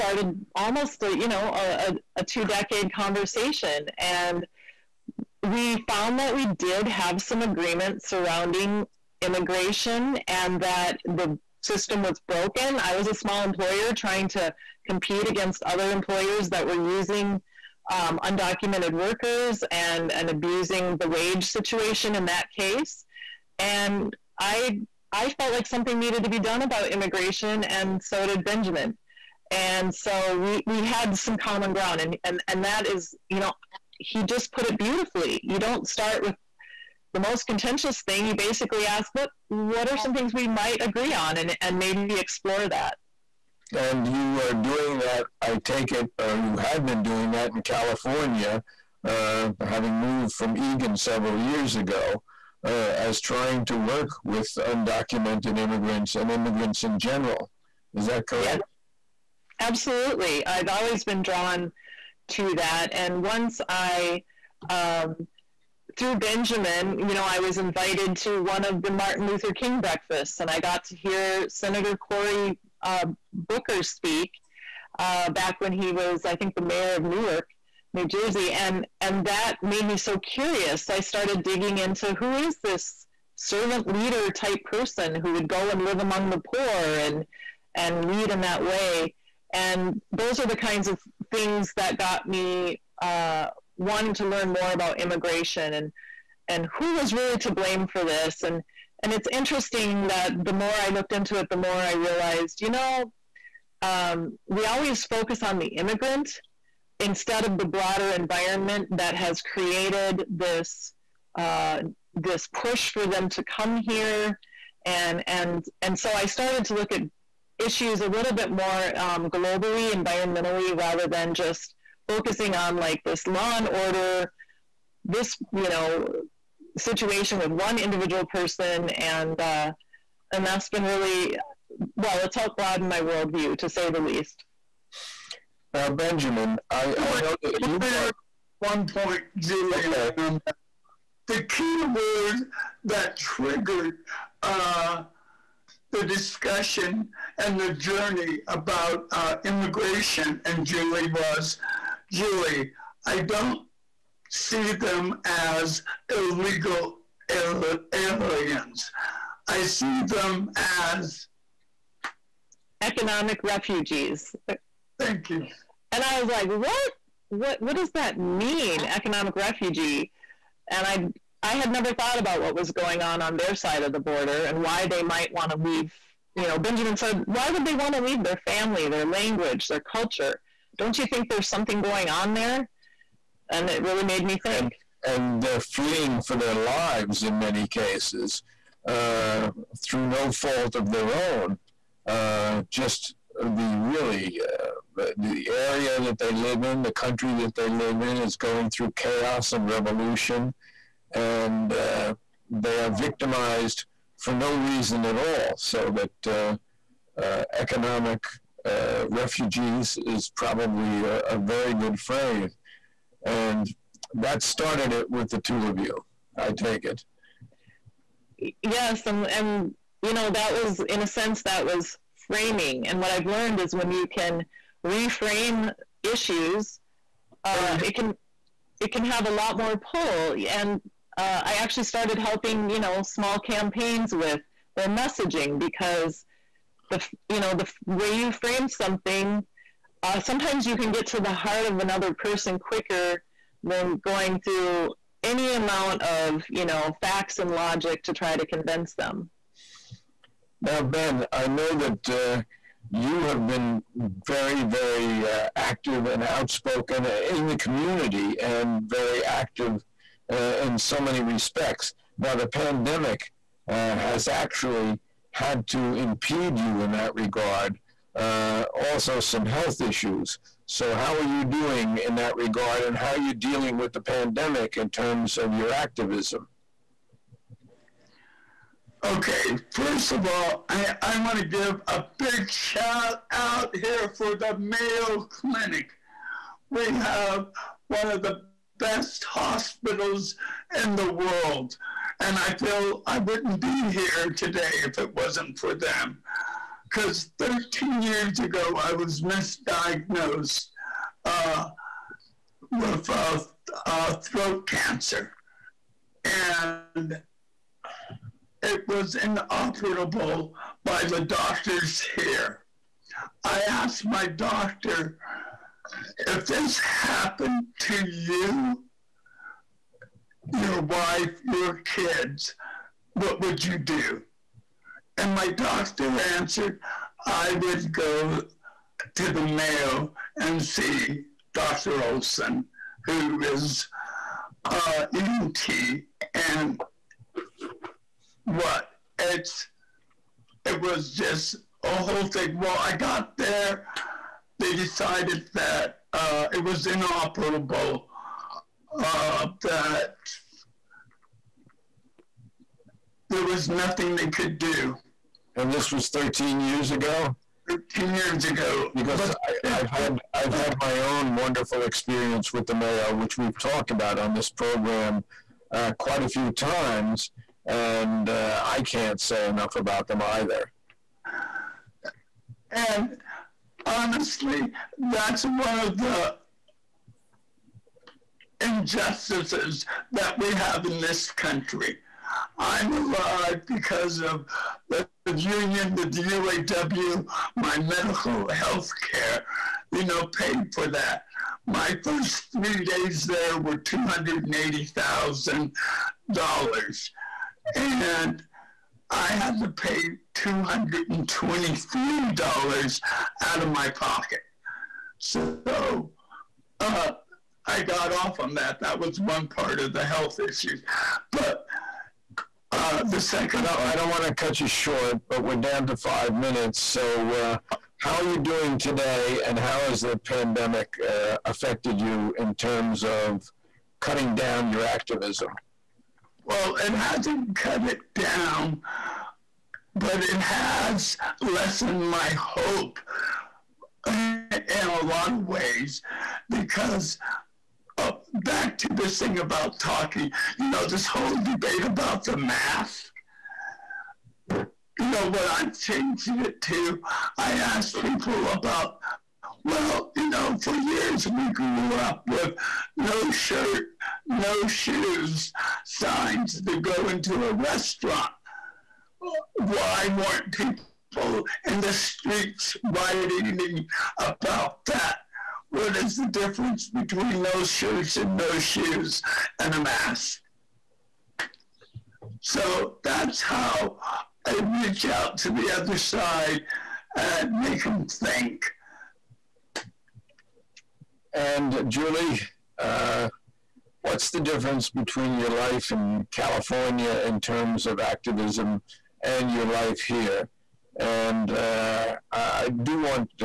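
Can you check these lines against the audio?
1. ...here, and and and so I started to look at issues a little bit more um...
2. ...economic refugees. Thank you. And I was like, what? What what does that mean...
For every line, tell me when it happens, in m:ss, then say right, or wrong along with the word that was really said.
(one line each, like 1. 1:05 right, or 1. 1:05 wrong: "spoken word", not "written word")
1. 1:53 right
2. 2:42 right.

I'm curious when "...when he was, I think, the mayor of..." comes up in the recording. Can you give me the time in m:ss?
1:15.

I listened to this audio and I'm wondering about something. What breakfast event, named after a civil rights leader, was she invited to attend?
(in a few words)
Martin Luther King breakfasts.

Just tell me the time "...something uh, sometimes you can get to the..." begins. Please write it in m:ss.
3:58.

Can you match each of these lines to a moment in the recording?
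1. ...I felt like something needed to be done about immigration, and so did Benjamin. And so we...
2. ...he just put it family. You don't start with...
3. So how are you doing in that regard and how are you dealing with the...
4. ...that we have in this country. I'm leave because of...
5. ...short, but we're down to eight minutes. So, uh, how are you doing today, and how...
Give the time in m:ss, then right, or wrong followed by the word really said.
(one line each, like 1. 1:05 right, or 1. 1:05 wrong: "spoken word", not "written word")
1. 0:25 right
2. 0:33 wrong: "beautifully", not "family"
3. 4:30 right
4. 6:20 wrong: "alive", not "leave"
5. 6:54 wrong: "five", not "eight".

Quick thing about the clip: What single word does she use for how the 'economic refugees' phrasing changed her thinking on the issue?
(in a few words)
framing.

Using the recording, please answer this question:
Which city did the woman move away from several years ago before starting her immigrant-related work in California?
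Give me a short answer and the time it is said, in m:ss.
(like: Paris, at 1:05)
Eagan, at 0:50.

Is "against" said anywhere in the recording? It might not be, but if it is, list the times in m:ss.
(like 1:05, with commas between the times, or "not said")
0:15.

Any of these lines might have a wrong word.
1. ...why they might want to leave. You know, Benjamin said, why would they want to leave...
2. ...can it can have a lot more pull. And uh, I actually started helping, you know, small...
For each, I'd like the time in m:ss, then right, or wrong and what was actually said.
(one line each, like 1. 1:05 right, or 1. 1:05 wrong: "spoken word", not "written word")
1. 2:54 right
2. 3:47 right.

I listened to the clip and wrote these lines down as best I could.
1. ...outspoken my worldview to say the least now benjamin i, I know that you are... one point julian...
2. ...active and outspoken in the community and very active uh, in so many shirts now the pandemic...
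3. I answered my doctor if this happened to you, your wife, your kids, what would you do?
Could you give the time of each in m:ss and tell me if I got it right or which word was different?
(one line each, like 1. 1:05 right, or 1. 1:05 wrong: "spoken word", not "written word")
1. 2:12 wrong: "broaden", not "outspoken"
2. 4:15 wrong: "respects", not "shirts"
3. 5:13 wrong: "asked", not "answered".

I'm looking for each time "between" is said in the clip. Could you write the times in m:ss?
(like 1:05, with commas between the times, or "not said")
7:46, 8:04.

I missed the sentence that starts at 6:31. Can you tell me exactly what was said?
My first three days there were $280,000.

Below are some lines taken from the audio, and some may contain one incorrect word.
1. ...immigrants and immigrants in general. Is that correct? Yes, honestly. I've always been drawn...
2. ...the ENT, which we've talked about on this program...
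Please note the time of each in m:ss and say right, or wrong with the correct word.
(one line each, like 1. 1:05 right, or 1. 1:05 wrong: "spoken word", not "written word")
1. 0:55 wrong: "absolutely", not "honestly"
2. 6:02 wrong: "Mayo", not "ENT".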